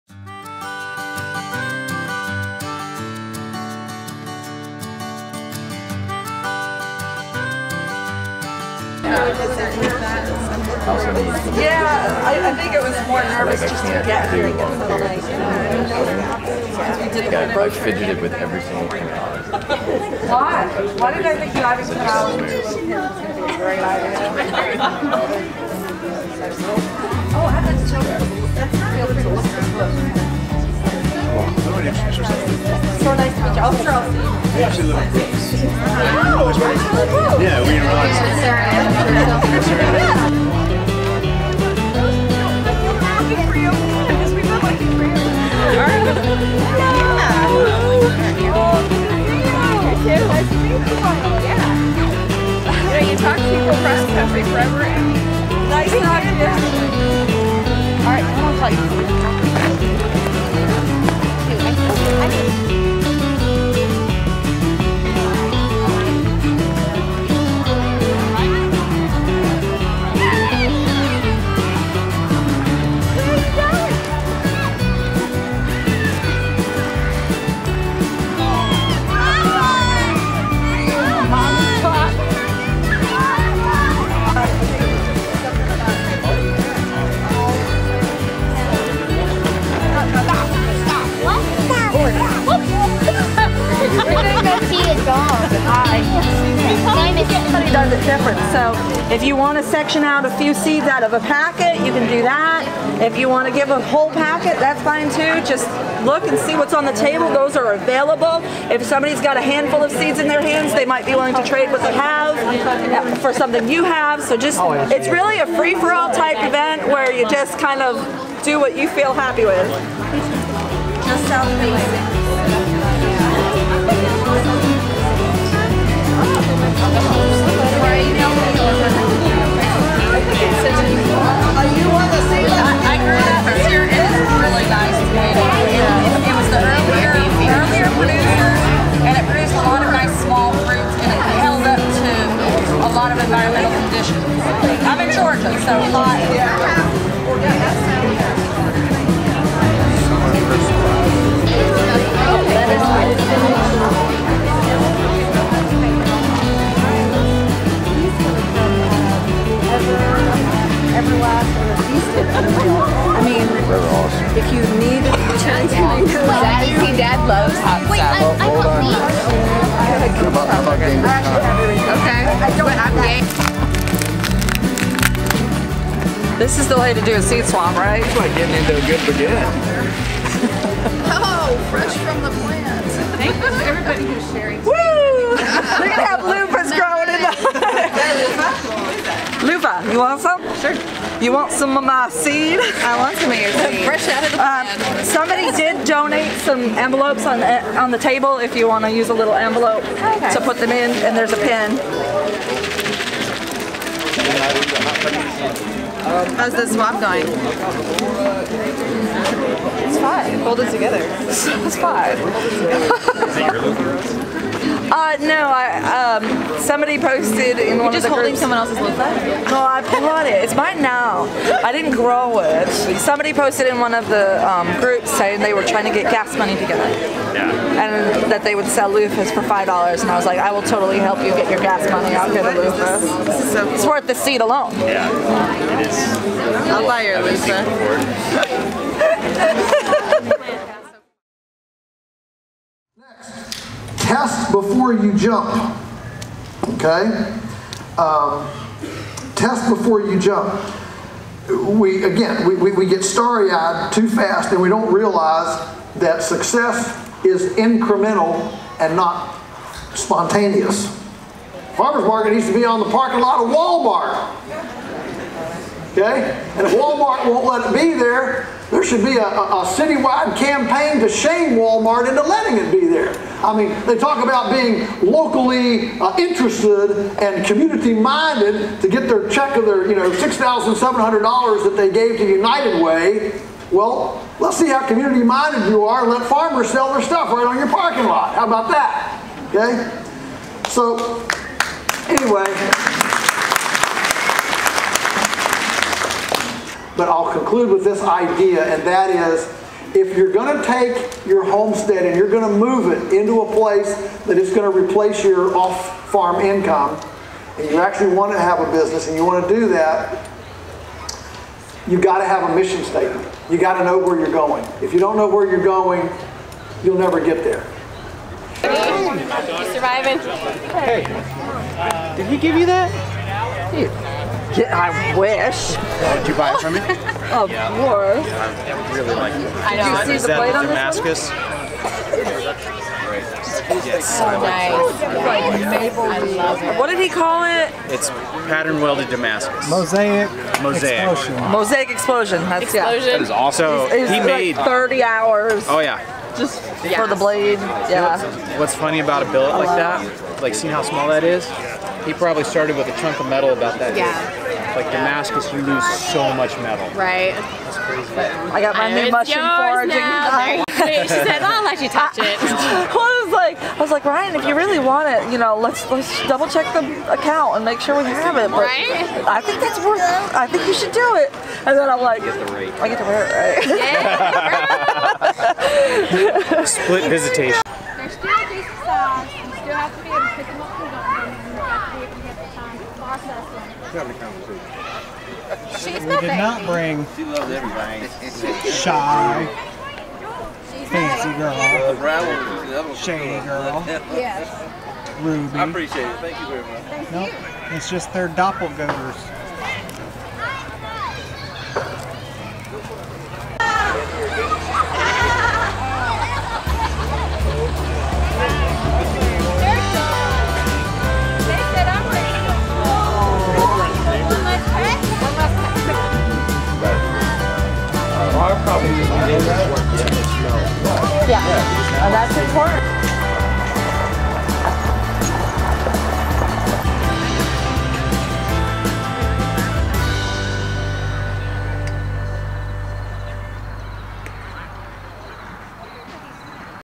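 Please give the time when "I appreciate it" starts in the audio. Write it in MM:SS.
06:35.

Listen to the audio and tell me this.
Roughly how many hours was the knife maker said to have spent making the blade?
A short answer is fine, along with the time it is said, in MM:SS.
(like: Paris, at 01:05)
30, at 05:44.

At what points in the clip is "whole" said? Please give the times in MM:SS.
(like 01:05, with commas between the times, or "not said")
01:43.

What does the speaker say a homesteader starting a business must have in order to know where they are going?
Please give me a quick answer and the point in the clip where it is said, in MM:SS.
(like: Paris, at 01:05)
A mission statement, at 05:12.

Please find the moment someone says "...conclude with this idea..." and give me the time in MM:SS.
04:57.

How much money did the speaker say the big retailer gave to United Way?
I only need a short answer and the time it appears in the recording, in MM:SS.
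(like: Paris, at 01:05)
$6,700, at 04:40.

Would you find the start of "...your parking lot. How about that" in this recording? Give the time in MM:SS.
04:47.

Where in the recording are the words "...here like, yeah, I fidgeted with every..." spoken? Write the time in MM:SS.
00:14.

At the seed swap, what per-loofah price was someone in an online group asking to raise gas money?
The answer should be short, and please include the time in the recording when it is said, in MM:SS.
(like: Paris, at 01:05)
$5, at 03:49.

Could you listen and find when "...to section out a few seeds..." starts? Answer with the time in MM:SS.
01:39.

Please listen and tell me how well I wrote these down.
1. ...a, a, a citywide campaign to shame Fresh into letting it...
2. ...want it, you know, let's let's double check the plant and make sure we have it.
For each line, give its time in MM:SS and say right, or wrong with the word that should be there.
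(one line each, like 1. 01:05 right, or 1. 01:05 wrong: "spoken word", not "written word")
1. 04:29 wrong: "Walmart", not "Fresh"
2. 06:04 wrong: "account", not "plant".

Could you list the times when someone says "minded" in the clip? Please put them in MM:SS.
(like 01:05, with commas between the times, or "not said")
04:37, 04:44.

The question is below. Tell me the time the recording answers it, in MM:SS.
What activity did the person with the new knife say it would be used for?
05:59.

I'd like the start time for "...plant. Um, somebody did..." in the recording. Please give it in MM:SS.
03:14.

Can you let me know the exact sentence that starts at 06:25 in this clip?
She's we did not bring she loves everybody.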